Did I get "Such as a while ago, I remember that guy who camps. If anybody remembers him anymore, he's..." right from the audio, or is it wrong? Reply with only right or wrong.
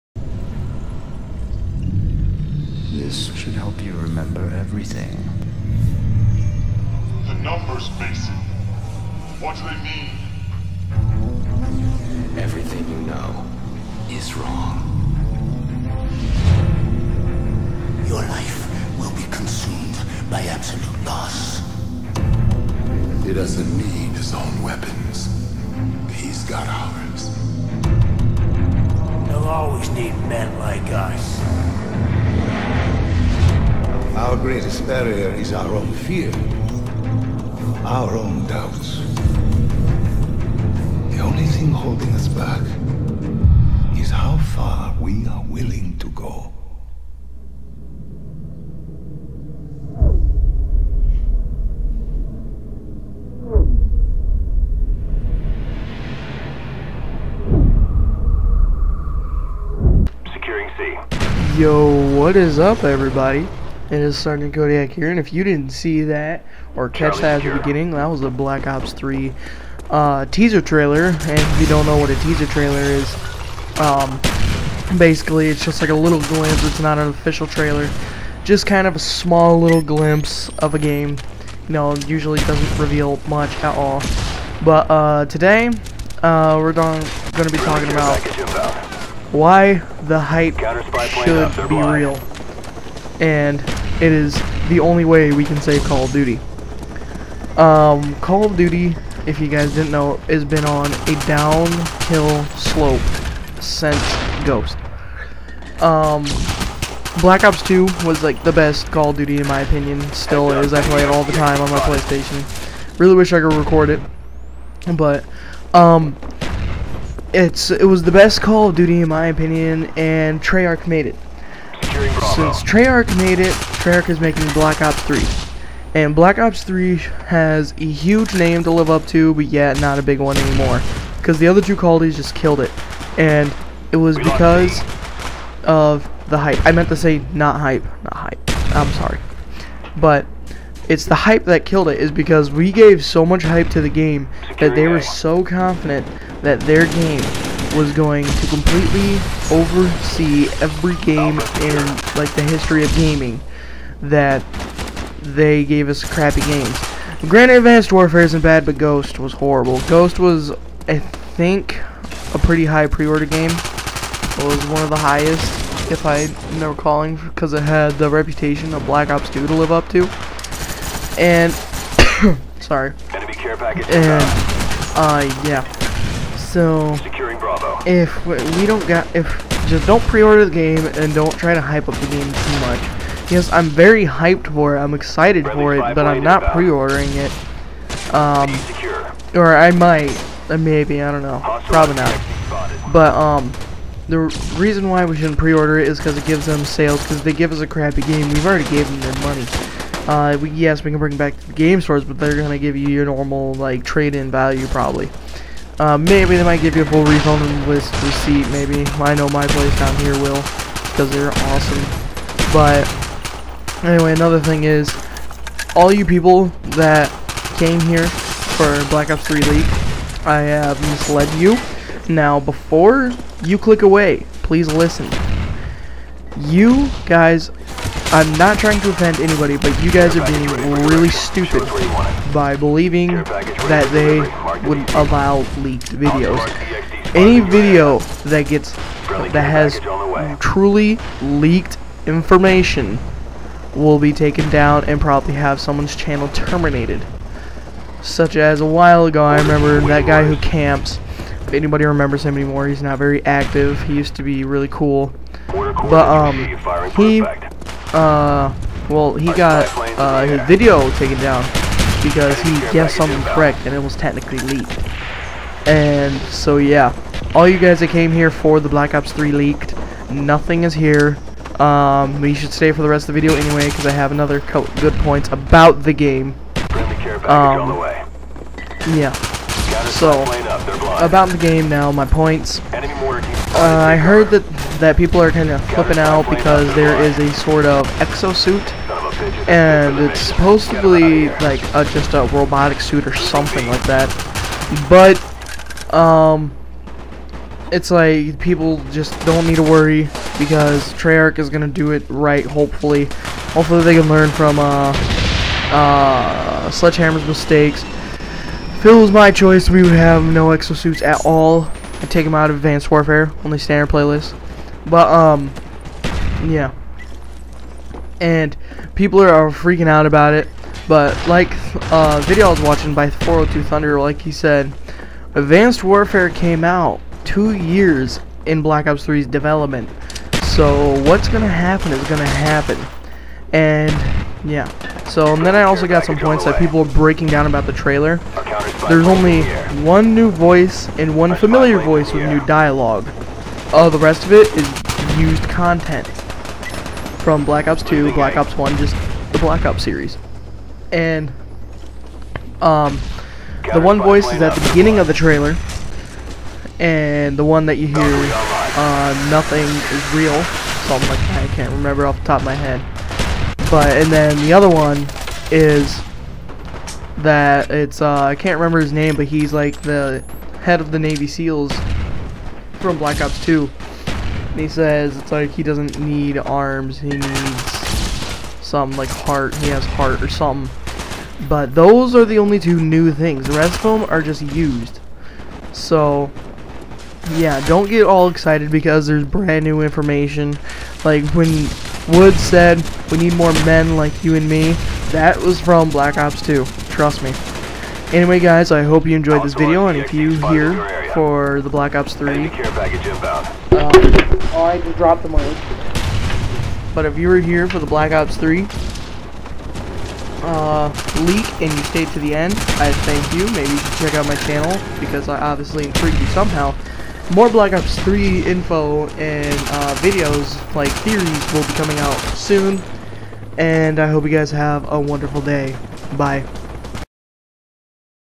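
right.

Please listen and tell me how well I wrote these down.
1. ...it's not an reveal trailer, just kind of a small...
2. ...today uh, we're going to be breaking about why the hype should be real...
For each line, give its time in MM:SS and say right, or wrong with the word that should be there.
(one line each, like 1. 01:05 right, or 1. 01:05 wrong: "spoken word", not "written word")
1. 01:16 wrong: "official", not "reveal"
2. 01:25 wrong: "talking", not "breaking".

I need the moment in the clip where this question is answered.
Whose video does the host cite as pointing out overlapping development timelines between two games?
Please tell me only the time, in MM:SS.
05:23.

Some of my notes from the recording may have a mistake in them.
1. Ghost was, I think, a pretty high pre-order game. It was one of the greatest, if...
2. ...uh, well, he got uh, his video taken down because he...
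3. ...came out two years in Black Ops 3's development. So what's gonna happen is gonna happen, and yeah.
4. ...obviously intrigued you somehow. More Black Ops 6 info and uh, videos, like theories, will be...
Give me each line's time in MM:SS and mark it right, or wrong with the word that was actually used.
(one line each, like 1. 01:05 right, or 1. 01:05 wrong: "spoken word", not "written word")
1. 02:39 wrong: "highest", not "greatest"
2. 04:17 right
3. 05:26 right
4. 06:55 wrong: "3", not "6".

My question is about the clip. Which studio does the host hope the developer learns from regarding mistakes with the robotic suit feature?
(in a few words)
Sledgehammer.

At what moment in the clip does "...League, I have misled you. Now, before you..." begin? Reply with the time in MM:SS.
03:39.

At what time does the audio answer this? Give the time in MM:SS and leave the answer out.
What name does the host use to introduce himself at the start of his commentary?
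01:04.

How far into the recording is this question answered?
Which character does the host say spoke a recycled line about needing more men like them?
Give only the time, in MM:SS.
06:32.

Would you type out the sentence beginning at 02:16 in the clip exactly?
I meant to say not hype, not hype.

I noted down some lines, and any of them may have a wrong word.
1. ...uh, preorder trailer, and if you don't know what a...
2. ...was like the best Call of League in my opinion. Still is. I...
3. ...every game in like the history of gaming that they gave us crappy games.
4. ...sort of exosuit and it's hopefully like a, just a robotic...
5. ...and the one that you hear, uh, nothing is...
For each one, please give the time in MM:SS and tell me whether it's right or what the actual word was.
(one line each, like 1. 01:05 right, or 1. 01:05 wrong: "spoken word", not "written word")
1. 01:09 wrong: "teaser", not "preorder"
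2. 01:48 wrong: "Duty", not "League"
3. 02:30 right
4. 04:47 wrong: "supposedly", not "hopefully"
5. 05:56 right.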